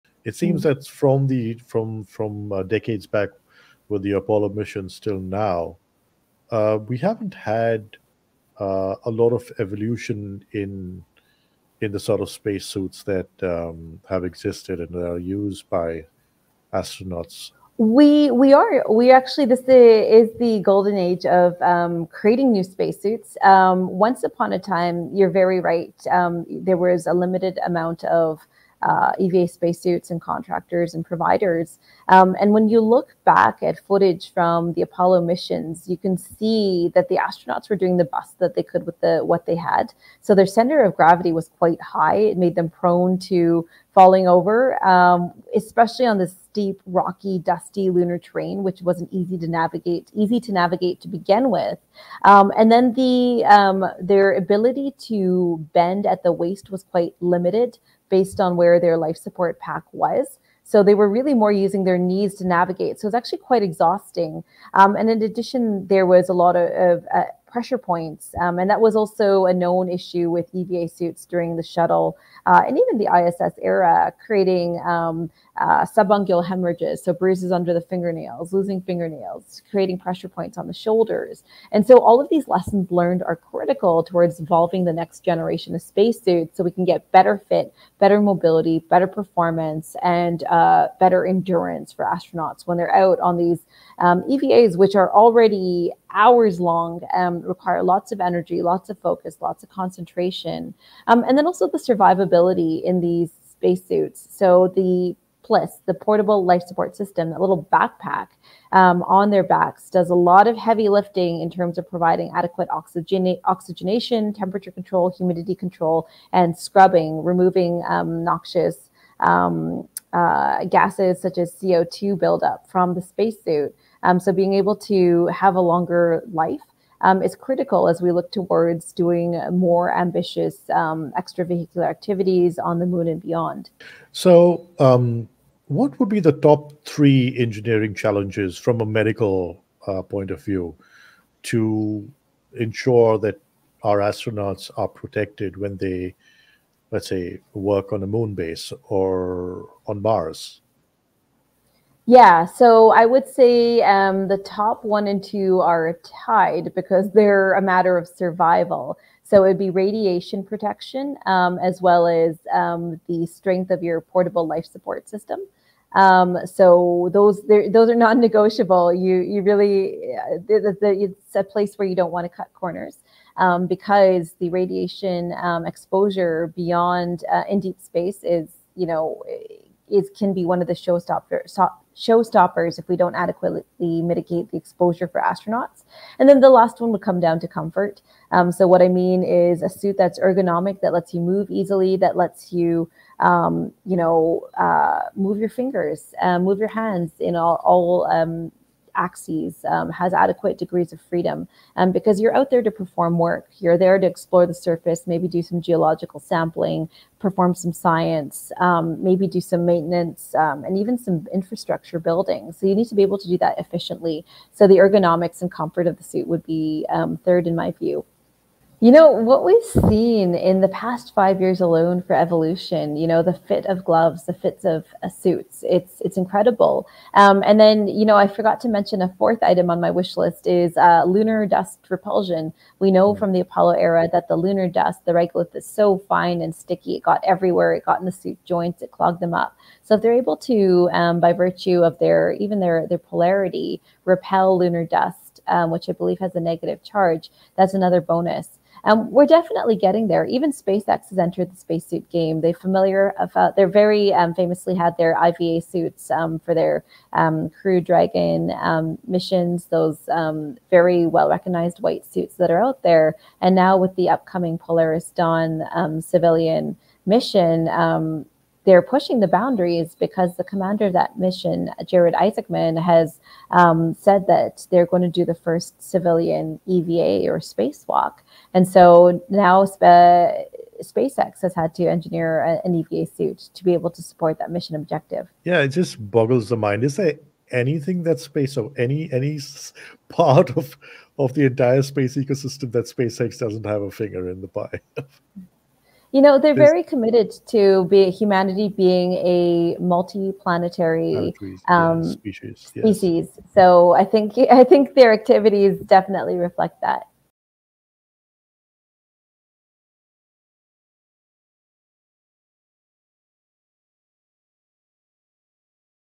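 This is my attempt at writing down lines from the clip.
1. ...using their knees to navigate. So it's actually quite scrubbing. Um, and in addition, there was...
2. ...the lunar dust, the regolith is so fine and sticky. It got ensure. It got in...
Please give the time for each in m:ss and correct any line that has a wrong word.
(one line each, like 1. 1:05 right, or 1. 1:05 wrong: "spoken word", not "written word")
1. 1:01 wrong: "exhausting", not "scrubbing"
2. 3:54 wrong: "everywhere", not "ensure".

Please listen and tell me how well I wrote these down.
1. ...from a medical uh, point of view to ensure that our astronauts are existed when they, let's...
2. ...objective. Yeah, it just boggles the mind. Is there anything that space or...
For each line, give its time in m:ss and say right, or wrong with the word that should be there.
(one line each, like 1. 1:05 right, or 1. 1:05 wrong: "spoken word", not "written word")
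1. 2:18 wrong: "protected", not "existed"
2. 4:44 right.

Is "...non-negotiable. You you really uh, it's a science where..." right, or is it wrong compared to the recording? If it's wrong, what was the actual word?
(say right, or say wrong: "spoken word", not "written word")
wrong: "place", not "science".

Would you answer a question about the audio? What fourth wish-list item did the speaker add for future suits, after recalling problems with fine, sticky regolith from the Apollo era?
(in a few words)
lunar dust repulsion.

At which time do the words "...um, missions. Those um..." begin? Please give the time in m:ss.
4:18.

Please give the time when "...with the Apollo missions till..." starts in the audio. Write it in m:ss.
0:03.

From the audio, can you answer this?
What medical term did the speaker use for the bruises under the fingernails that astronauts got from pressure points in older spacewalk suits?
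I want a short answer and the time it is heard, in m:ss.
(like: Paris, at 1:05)
subungual hemorrhages, at 1:15.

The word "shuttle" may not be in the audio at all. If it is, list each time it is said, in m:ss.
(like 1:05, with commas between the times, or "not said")
1:11.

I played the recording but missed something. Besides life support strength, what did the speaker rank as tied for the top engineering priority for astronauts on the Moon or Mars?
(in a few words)
radiation protection.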